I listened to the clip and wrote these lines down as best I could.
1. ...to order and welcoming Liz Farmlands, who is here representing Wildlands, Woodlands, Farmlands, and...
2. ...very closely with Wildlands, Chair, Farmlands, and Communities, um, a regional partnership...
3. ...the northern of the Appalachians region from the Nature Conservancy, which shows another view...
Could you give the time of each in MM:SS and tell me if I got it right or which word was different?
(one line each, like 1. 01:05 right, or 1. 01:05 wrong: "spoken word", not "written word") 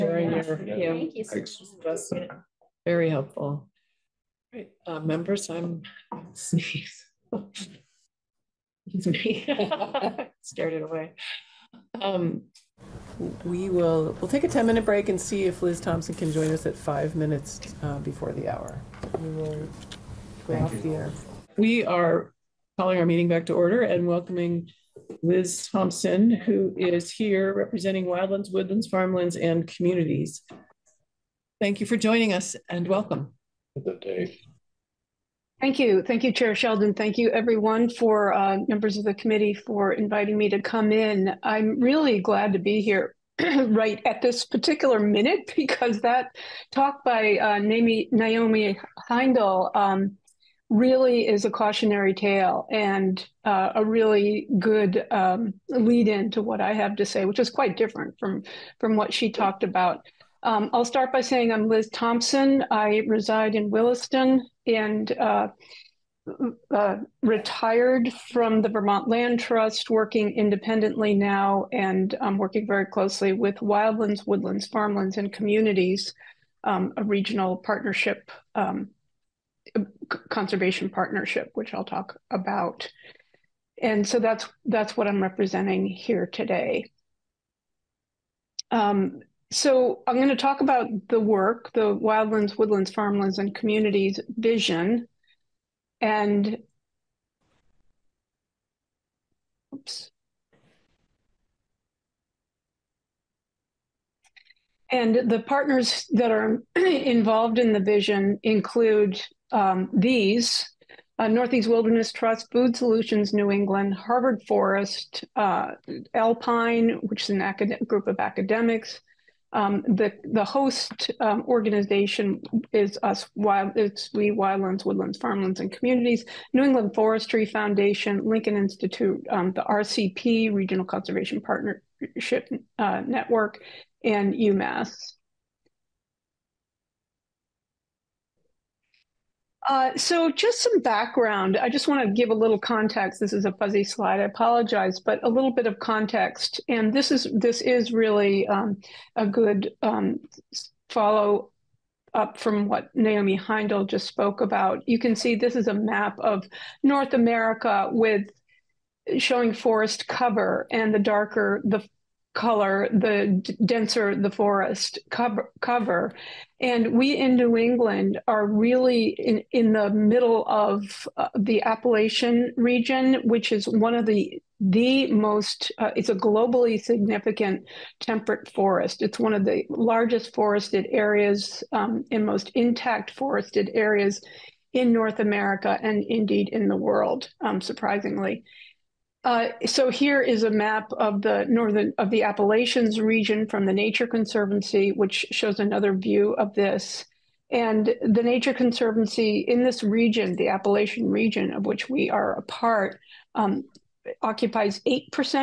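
1. 00:23 wrong: "Thompson", not "Farmlands"
2. 01:12 wrong: "Woodlands", not "Chair"
3. 03:11 right.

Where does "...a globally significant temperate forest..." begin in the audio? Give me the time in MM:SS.
02:56.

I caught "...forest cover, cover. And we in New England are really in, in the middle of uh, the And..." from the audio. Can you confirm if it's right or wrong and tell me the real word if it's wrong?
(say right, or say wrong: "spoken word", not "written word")
wrong: "Appalachian", not "And".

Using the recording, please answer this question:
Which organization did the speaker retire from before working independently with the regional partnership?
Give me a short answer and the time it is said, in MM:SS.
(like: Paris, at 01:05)
Vermont Land Trust, at 01:08.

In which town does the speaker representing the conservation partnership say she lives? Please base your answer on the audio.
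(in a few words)
Williston.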